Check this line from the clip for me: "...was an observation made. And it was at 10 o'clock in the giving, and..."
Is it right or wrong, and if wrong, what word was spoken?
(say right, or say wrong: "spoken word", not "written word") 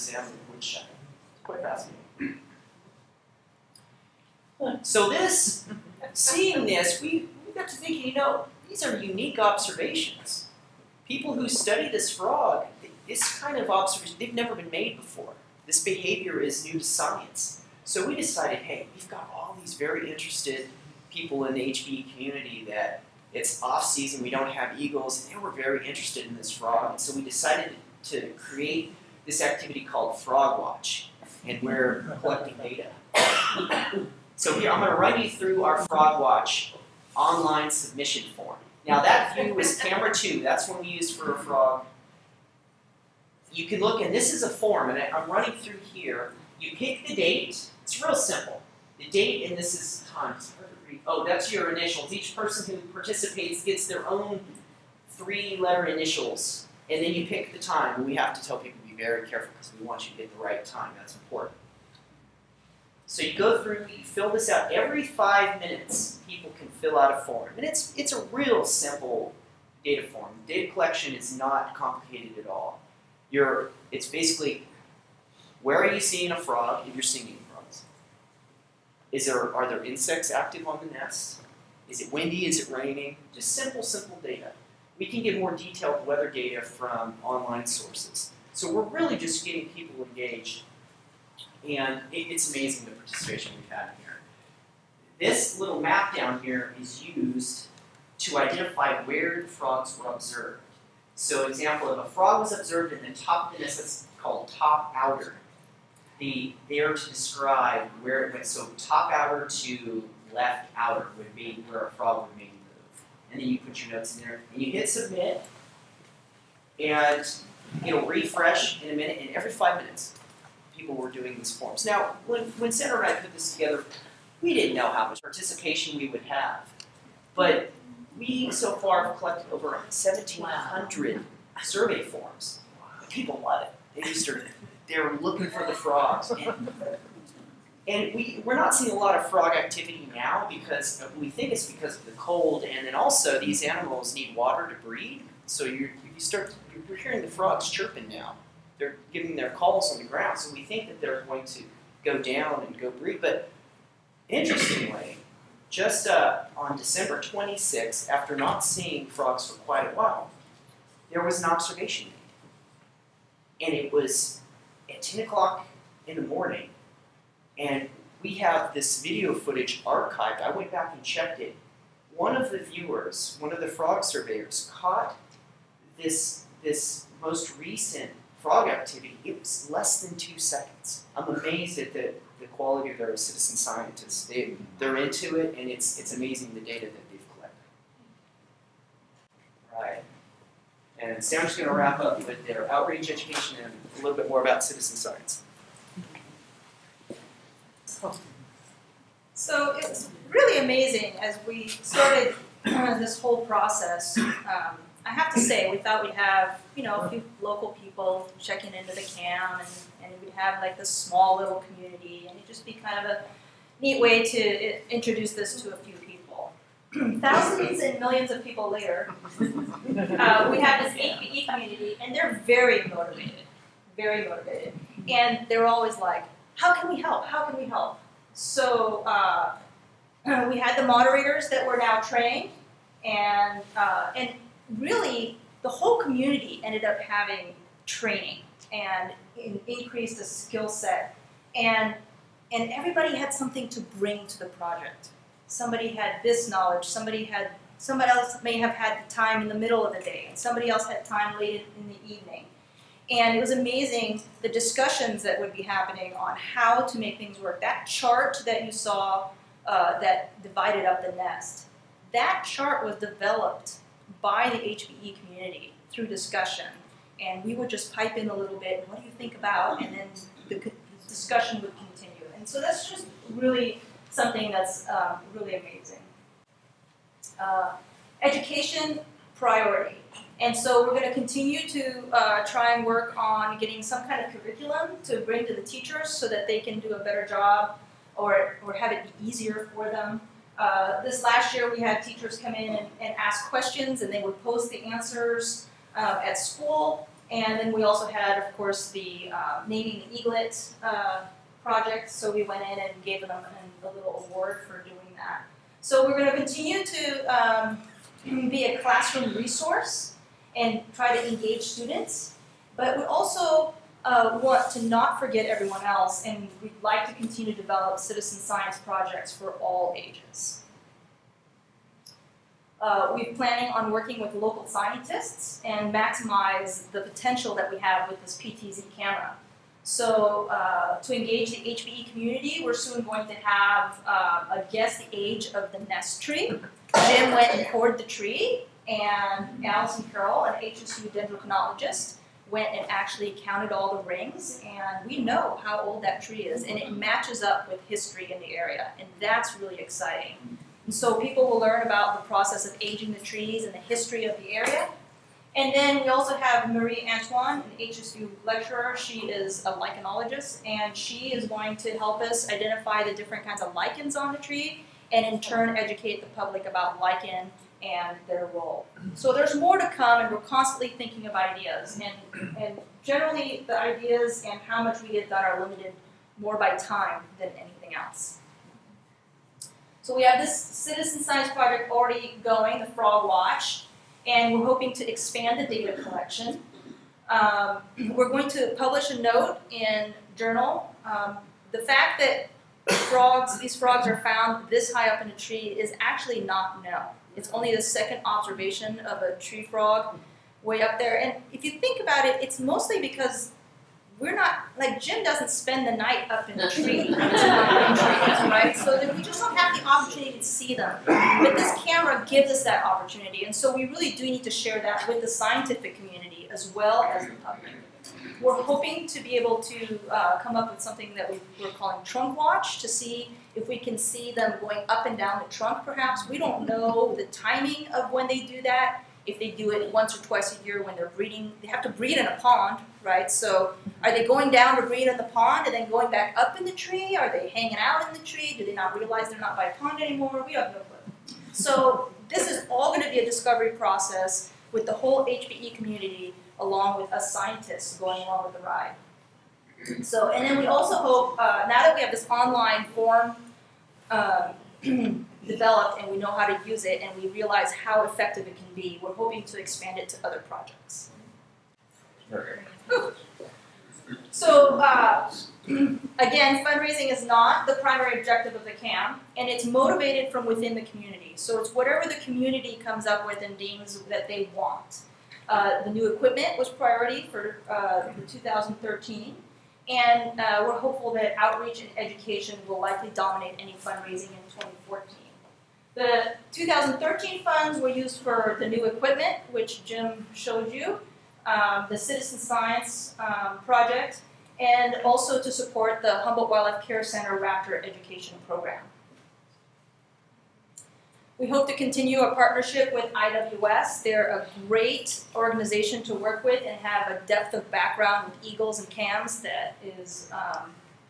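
wrong: "morning", not "giving".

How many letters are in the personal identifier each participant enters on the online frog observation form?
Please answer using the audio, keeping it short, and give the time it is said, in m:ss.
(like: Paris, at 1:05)
3, at 0:55.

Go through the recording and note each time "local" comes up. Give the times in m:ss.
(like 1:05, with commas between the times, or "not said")
3:27, 5:24.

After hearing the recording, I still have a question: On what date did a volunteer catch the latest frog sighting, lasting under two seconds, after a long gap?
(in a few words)
December 26.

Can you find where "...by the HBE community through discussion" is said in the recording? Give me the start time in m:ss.
4:24.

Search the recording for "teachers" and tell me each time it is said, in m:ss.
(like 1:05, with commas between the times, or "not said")
4:45, 4:52.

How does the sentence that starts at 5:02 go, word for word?
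So we went in and gave them a, a little award for doing that.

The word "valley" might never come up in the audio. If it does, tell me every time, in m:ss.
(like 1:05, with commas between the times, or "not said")
not said.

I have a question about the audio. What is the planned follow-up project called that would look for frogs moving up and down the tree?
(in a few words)
Trunk Watch.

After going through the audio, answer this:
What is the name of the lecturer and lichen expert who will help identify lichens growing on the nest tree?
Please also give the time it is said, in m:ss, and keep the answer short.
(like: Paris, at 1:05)
Marie Antoine, at 5:56.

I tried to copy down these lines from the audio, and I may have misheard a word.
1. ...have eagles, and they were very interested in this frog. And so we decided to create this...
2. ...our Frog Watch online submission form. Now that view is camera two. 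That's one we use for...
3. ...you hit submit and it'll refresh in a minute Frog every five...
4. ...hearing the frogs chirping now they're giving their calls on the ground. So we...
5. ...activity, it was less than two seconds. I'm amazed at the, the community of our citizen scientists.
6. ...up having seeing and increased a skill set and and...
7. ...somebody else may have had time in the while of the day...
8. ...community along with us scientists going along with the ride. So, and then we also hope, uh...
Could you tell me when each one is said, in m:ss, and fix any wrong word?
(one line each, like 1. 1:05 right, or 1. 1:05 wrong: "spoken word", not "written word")
1. 0:24 right
2. 0:35 right
3. 1:54 wrong: "And", not "Frog"
4. 2:26 right
5. 2:58 wrong: "quality", not "community"
6. 3:56 wrong: "training", not "seeing"
7. 4:07 wrong: "middle", not "while"
8. 7:25 right.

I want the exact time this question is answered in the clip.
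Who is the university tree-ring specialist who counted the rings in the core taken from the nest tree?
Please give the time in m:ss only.
5:39.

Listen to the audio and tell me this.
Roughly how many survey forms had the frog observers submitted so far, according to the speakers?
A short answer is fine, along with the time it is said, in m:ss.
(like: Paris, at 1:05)
Over 1,700, at 2:09.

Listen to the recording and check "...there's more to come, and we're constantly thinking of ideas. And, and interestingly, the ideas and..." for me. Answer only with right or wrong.
wrong.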